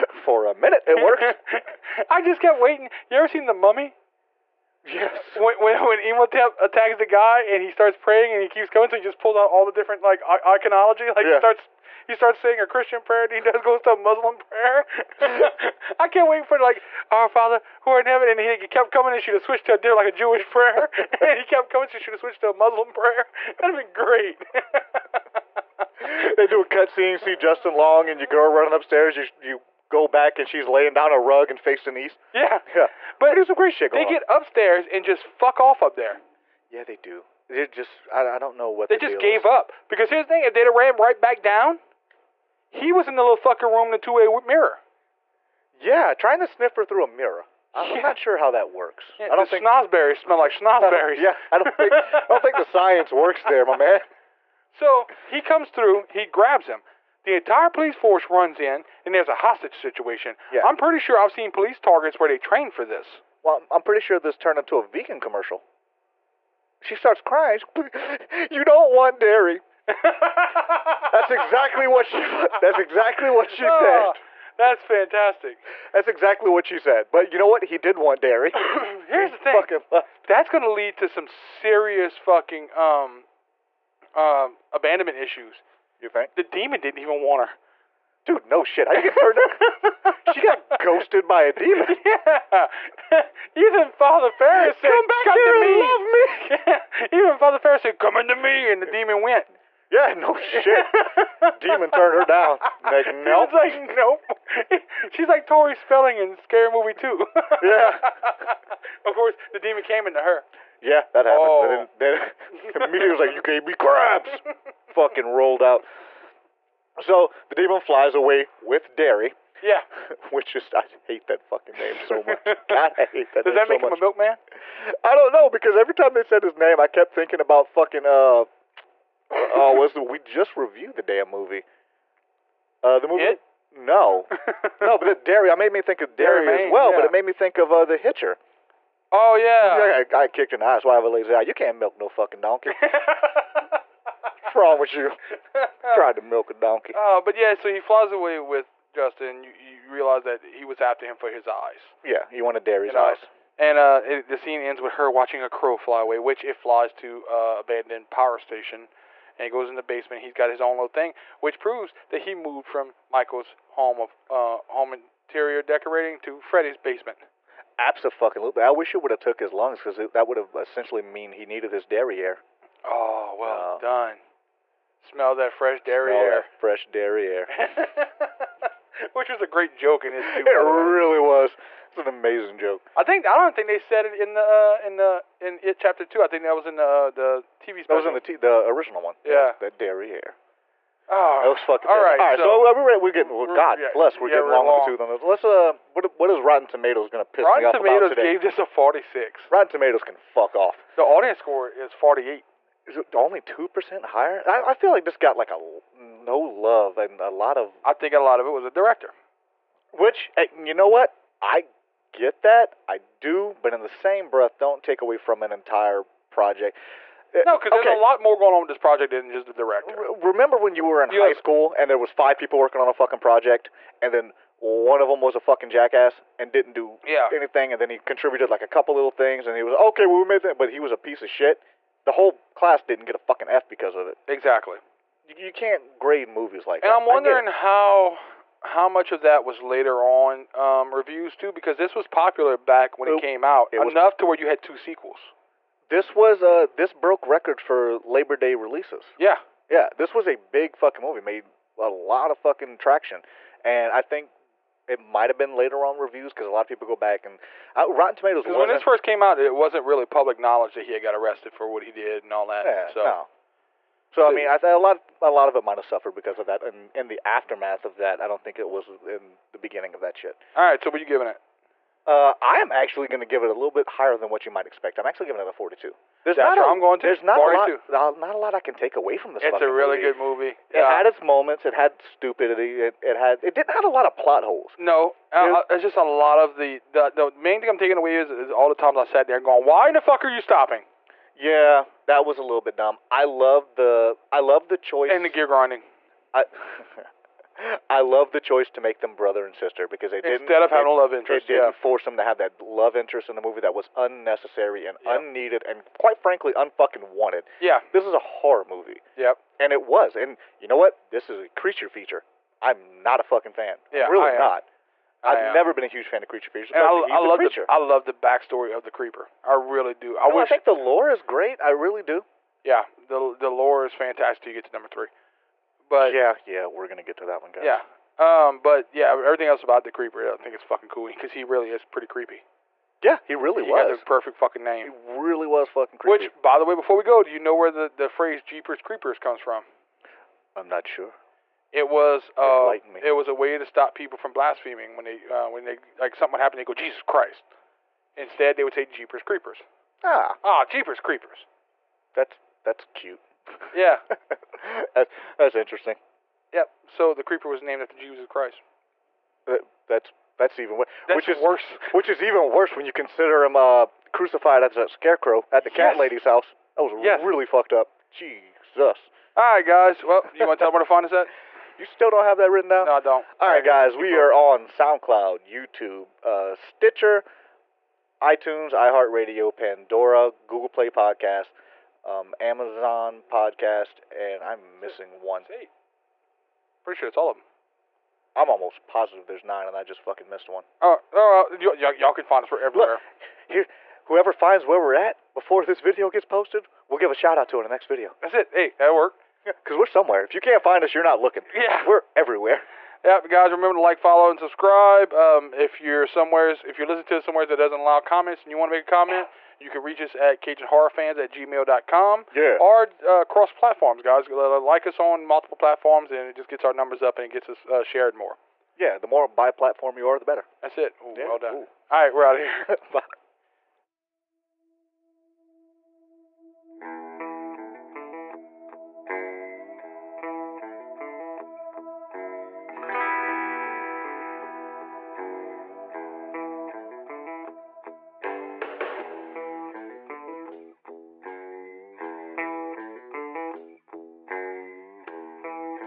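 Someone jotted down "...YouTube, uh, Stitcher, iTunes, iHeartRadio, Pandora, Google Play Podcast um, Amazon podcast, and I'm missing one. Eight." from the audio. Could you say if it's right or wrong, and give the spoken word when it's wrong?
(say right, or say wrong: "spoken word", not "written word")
right.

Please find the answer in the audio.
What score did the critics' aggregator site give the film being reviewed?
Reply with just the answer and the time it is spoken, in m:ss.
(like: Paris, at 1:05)
46, at 3:18.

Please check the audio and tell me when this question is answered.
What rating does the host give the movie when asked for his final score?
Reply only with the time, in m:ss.
4:35.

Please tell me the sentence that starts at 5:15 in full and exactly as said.
I have never been a huge fan of creature features.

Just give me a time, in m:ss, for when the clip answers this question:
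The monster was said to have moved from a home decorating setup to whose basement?
2:46.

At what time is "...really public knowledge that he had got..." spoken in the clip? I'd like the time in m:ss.
4:19.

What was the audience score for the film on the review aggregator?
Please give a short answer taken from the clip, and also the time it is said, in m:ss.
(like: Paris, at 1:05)
48, at 3:21.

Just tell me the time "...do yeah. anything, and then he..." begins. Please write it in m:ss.
3:46.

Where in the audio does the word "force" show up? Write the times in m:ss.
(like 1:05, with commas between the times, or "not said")
0:57, 5:01.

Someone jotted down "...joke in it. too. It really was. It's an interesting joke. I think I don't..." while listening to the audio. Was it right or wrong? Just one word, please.
wrong.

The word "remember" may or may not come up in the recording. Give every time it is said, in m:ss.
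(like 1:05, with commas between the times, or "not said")
3:40, 6:43.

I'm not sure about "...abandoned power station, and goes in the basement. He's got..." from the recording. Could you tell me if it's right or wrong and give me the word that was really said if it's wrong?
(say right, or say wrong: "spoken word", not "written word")
right.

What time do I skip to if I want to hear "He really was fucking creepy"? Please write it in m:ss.
5:35.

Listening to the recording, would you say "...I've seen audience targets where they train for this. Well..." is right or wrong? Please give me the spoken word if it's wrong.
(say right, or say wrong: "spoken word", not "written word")
wrong: "police", not "audience".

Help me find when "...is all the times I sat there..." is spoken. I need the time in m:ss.
4:48.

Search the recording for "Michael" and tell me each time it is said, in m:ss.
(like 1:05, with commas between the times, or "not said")
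2:43.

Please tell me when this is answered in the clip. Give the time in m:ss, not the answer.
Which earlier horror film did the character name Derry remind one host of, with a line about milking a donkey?
2:17.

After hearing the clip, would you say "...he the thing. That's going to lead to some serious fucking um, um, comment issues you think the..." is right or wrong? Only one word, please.
wrong.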